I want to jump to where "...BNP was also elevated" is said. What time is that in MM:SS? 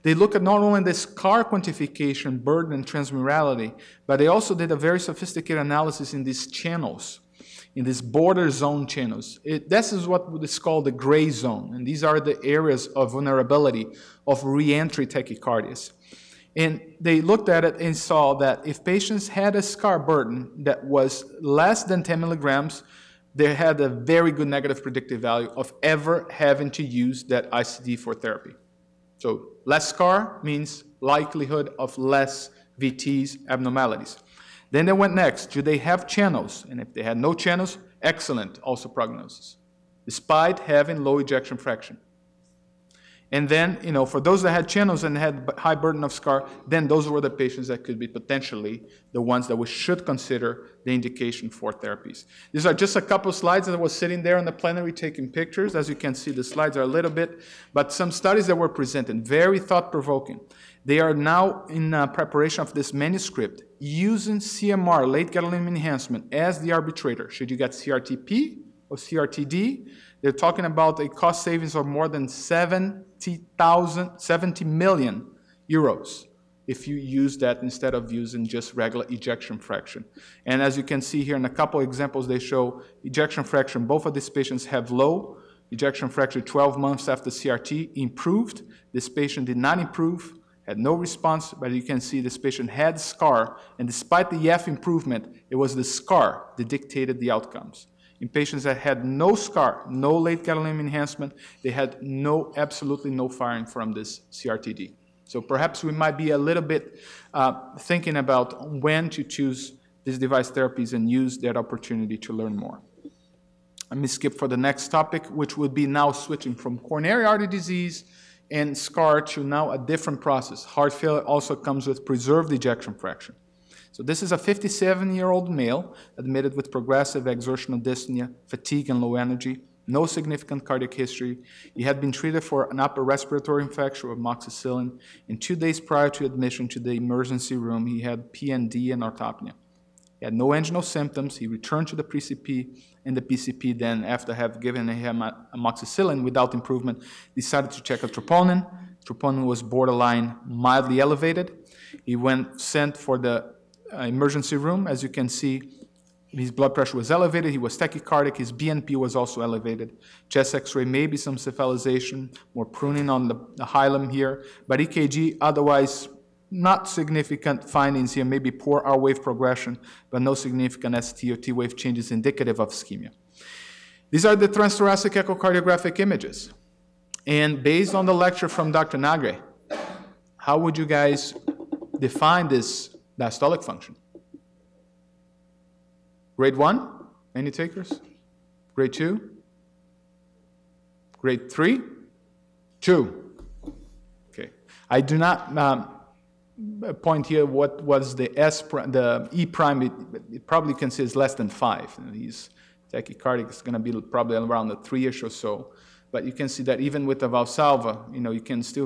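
02:38.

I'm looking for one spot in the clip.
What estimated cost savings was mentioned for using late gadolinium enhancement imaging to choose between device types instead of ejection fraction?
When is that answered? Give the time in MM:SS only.
01:14.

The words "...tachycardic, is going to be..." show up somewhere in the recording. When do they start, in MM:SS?
03:22.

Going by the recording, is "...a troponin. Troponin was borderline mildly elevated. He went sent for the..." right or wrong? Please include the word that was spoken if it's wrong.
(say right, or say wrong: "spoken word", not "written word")
right.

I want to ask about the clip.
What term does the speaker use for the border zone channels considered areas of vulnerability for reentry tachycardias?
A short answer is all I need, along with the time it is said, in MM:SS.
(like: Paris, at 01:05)
gray zone, at 00:10.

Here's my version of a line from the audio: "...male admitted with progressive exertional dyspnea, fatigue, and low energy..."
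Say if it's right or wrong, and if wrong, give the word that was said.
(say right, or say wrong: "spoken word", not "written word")
right.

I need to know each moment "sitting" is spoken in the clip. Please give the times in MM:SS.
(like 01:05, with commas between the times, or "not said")
00:53.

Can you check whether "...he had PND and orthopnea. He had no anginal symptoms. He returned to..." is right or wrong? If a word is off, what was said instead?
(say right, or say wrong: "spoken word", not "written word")
right.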